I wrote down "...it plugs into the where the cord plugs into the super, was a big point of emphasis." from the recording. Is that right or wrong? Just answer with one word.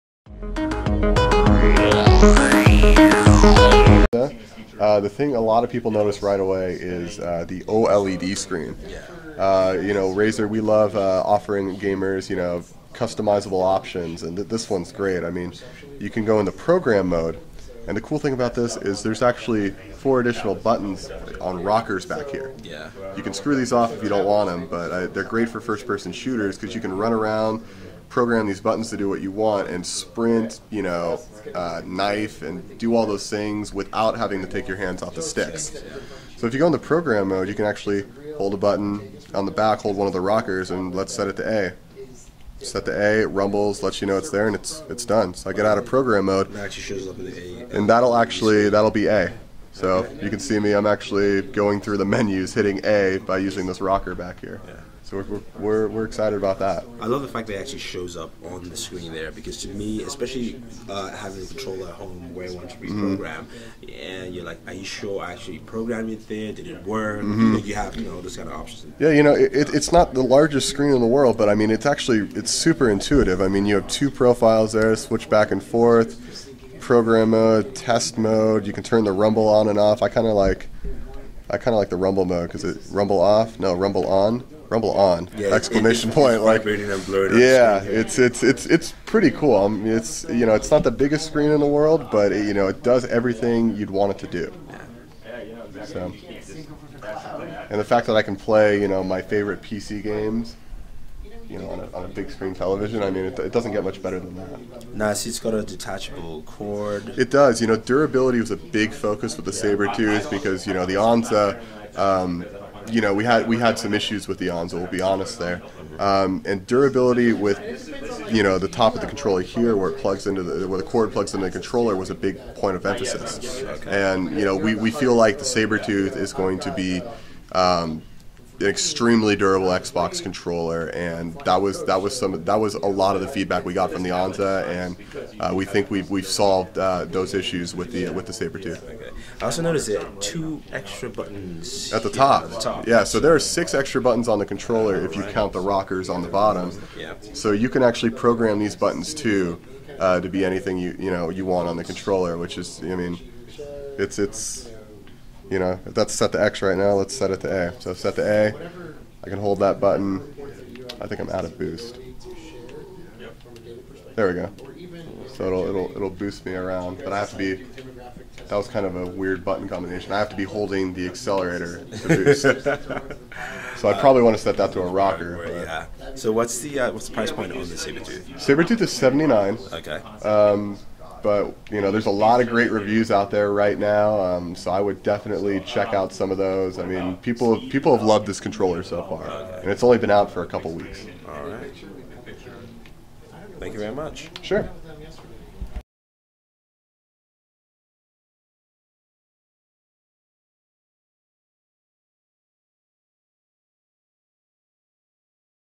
wrong.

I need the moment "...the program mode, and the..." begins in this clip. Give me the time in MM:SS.
00:16.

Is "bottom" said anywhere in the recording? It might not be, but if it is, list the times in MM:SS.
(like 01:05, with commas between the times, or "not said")
02:26.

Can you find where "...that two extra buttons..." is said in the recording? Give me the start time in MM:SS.
02:19.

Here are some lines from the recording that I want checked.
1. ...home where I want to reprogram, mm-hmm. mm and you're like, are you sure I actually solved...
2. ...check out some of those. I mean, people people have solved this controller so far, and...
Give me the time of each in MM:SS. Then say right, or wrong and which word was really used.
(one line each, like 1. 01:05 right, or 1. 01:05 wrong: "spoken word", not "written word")
1. 01:01 wrong: "programmed", not "solved"
2. 03:05 wrong: "loved", not "solved".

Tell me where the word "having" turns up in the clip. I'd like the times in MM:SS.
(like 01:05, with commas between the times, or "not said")
00:34, 01:01.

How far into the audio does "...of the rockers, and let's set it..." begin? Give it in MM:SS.
00:40.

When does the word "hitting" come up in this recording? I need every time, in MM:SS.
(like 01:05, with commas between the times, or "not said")
00:52.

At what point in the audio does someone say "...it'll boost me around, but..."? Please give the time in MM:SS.
02:45.